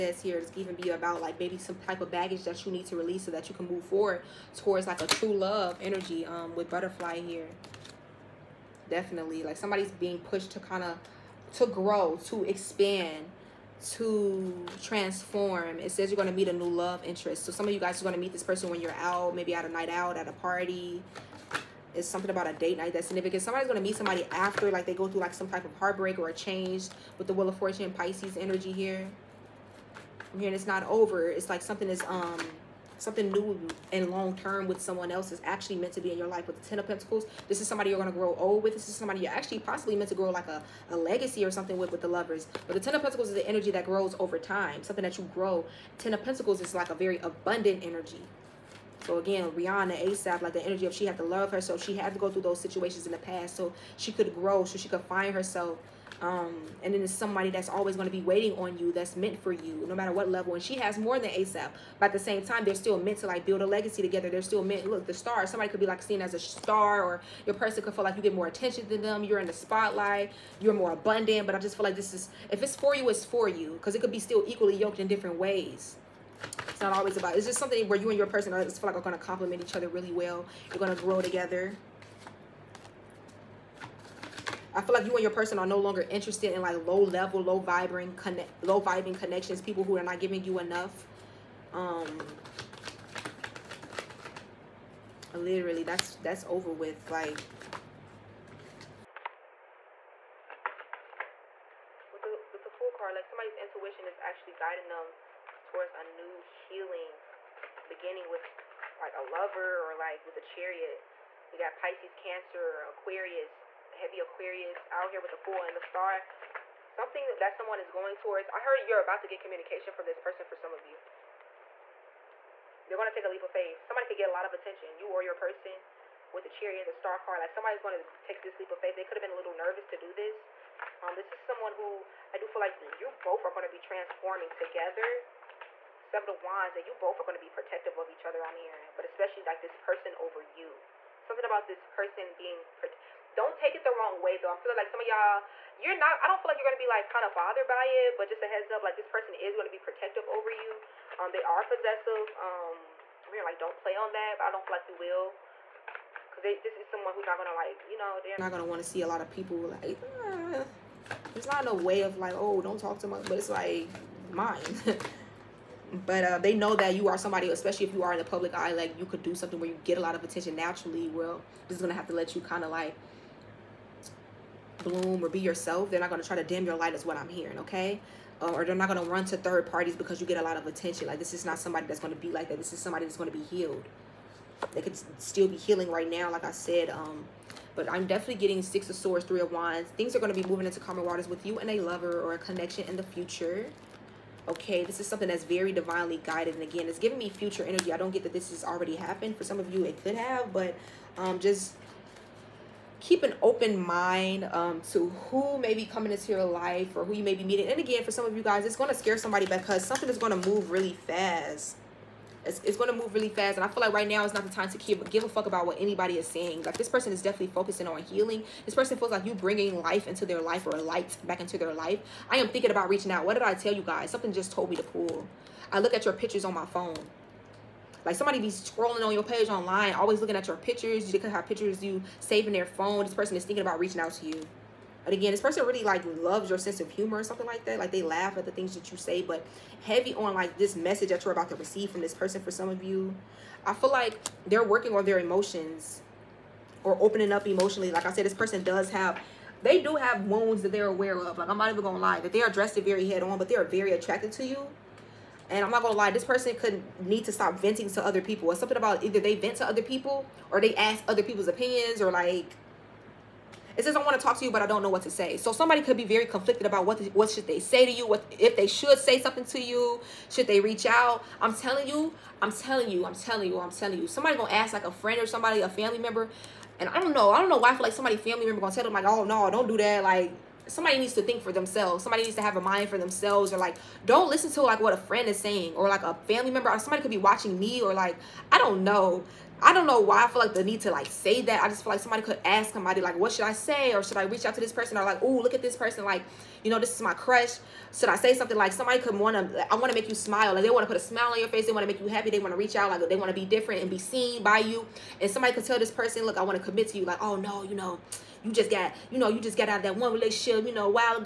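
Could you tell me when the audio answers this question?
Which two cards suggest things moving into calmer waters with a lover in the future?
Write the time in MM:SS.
03:08.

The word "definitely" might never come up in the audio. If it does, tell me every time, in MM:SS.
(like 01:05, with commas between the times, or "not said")
00:08, 03:08, 03:37.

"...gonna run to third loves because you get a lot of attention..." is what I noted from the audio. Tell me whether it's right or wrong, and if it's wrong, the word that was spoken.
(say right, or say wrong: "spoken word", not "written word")
wrong: "parties", not "loves".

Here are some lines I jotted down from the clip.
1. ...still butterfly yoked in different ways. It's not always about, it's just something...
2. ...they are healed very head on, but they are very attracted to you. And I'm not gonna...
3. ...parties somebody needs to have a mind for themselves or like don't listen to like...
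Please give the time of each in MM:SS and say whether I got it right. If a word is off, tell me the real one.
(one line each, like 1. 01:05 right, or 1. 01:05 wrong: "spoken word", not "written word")
1. 01:14 wrong: "equally", not "butterfly"
2. 04:12 wrong: "dressed", not "healed"
3. 04:41 wrong: "themselves", not "parties".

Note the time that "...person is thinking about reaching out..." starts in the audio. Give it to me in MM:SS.
03:53.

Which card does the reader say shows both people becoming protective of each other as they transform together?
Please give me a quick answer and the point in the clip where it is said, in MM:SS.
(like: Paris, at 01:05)
Seven of Wands, at 02:16.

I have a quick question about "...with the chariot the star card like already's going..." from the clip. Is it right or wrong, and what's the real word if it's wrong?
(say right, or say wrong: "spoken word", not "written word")
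wrong: "somebody", not "already".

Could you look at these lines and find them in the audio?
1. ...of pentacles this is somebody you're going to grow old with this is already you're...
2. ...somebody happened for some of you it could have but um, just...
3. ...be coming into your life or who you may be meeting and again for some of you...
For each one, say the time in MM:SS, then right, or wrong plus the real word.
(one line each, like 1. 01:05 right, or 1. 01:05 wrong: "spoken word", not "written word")
1. 00:36 wrong: "somebody", not "already"
2. 03:18 wrong: "already", not "somebody"
3. 03:25 right.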